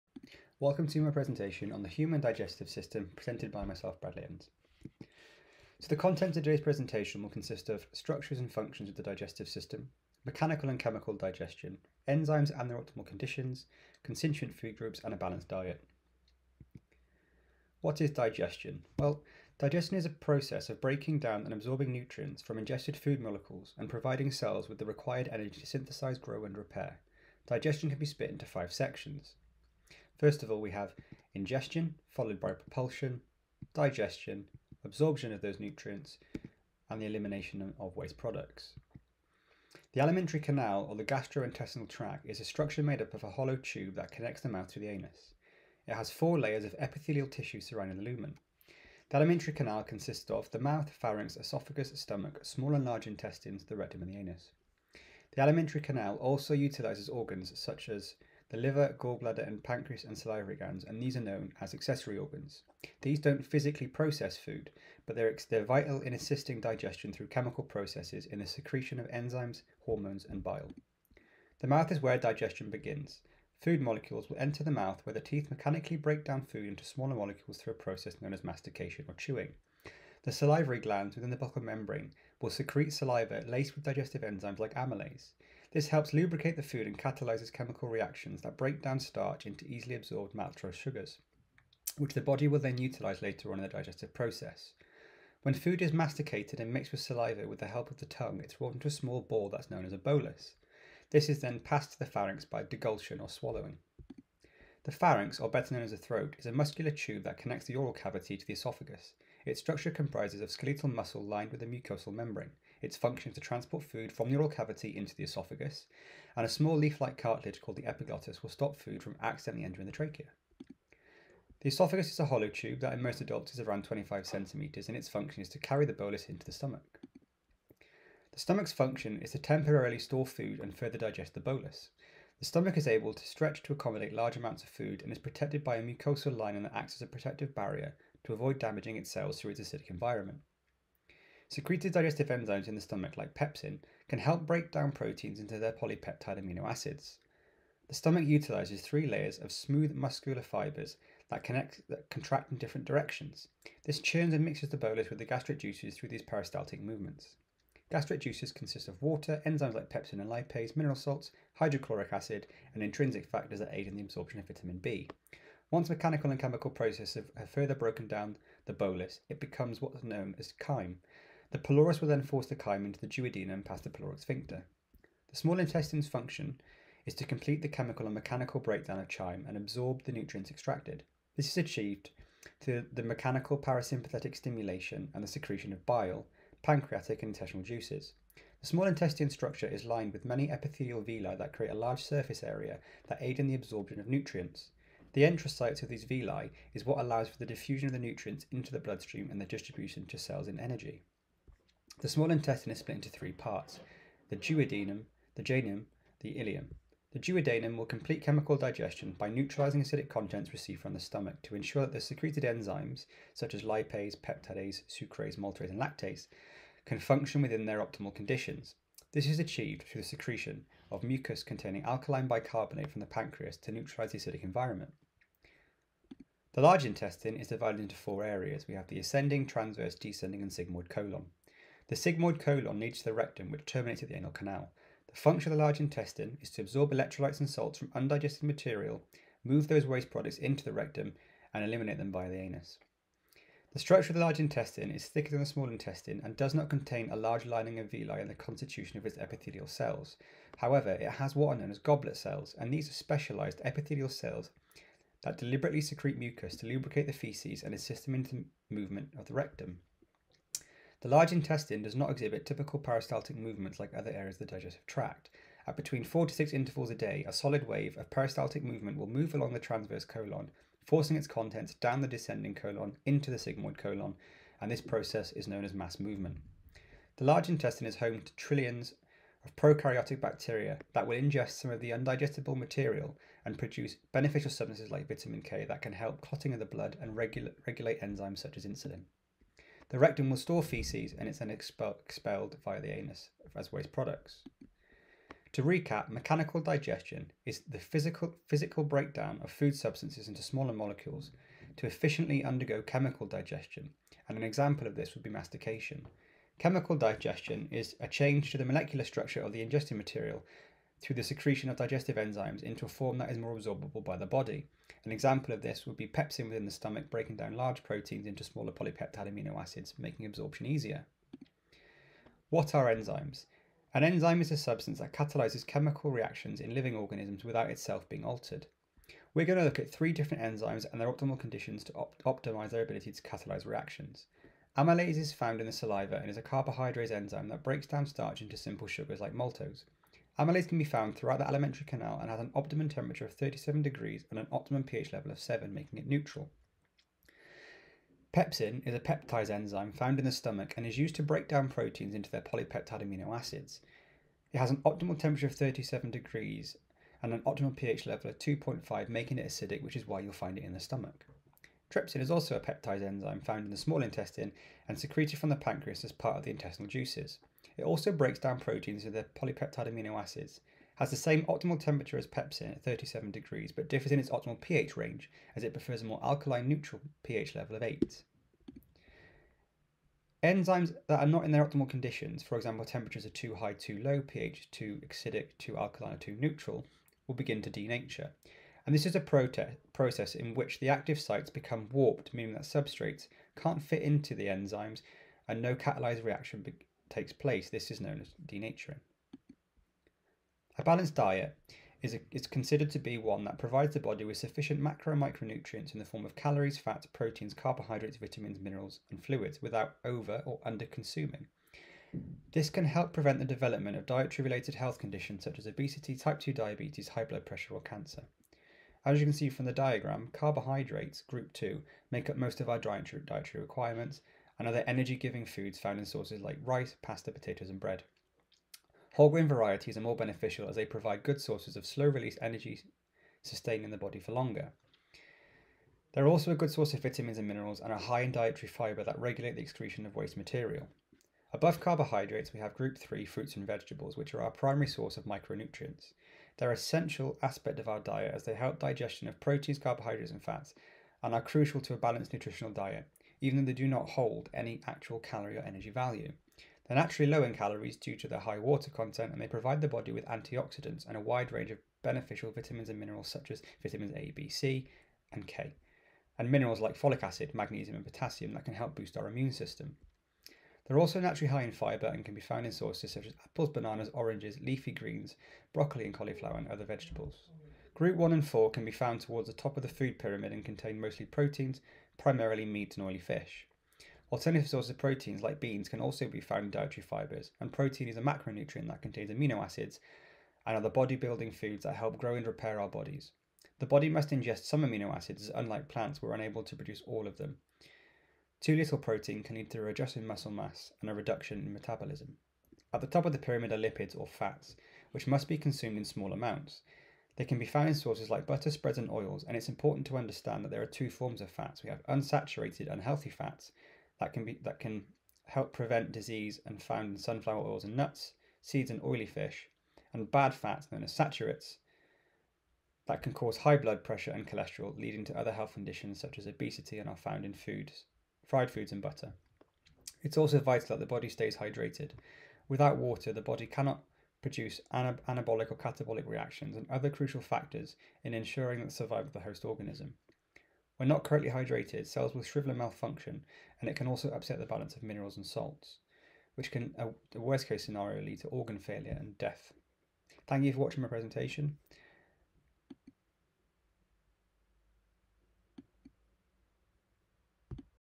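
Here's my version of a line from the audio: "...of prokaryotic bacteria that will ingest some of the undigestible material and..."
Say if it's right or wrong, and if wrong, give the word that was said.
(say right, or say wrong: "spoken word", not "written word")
right.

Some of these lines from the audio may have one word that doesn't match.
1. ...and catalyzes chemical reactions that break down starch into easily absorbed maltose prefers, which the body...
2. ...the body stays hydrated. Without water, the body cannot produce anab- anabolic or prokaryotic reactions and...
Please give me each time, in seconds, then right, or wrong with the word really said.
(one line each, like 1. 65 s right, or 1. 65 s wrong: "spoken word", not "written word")
1. 86 s wrong: "sugars", not "prefers"
2. 530 s wrong: "catabolic", not "prokaryotic".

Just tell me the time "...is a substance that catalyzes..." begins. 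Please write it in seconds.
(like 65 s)
324 s.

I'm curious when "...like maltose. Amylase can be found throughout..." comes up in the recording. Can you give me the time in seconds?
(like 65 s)
339 s.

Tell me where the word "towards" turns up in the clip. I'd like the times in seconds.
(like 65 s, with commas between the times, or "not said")
479 s.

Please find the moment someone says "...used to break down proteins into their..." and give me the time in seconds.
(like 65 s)
350 s.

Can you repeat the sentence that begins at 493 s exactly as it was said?
The body must ingest some amino acids, as unlike plants, we're unable to produce all of them.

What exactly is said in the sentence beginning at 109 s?
Its structure comprises of skeletal muscle lined with a mucosal membrane.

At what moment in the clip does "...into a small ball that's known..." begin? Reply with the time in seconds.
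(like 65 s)
98 s.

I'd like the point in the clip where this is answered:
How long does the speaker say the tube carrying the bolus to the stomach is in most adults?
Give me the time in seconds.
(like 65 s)
123 s.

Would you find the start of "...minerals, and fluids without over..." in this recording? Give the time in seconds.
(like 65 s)
408 s.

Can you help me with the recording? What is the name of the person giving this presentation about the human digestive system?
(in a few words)
Bradley Evans.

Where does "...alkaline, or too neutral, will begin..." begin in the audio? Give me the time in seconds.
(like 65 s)
385 s.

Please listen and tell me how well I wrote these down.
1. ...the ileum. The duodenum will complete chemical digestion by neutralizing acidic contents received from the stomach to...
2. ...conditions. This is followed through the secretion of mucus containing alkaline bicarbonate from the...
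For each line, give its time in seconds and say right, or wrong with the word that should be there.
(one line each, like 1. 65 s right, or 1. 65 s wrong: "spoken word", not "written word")
1. 206 s right
2. 218 s wrong: "achieved", not "followed".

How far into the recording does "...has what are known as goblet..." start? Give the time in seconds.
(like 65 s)
251 s.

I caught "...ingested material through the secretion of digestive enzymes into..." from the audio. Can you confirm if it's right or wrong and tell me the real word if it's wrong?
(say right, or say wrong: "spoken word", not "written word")
right.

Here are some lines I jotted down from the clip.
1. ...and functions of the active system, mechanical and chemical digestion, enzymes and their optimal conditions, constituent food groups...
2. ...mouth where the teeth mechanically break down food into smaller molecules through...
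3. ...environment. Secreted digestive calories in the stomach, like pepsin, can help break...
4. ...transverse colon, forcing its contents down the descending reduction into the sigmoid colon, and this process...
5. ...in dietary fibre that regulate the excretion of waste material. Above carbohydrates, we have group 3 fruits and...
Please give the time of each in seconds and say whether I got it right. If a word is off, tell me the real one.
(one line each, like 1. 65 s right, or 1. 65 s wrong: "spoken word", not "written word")
1. 8 s wrong: "digestive", not "active"
2. 74 s right
3. 139 s wrong: "enzymes", not "calories"
4. 269 s wrong: "colon", not "reduction"
5. 438 s right.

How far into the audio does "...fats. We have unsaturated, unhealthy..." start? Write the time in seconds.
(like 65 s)
511 s.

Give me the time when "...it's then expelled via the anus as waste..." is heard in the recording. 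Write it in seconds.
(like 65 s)
291 s.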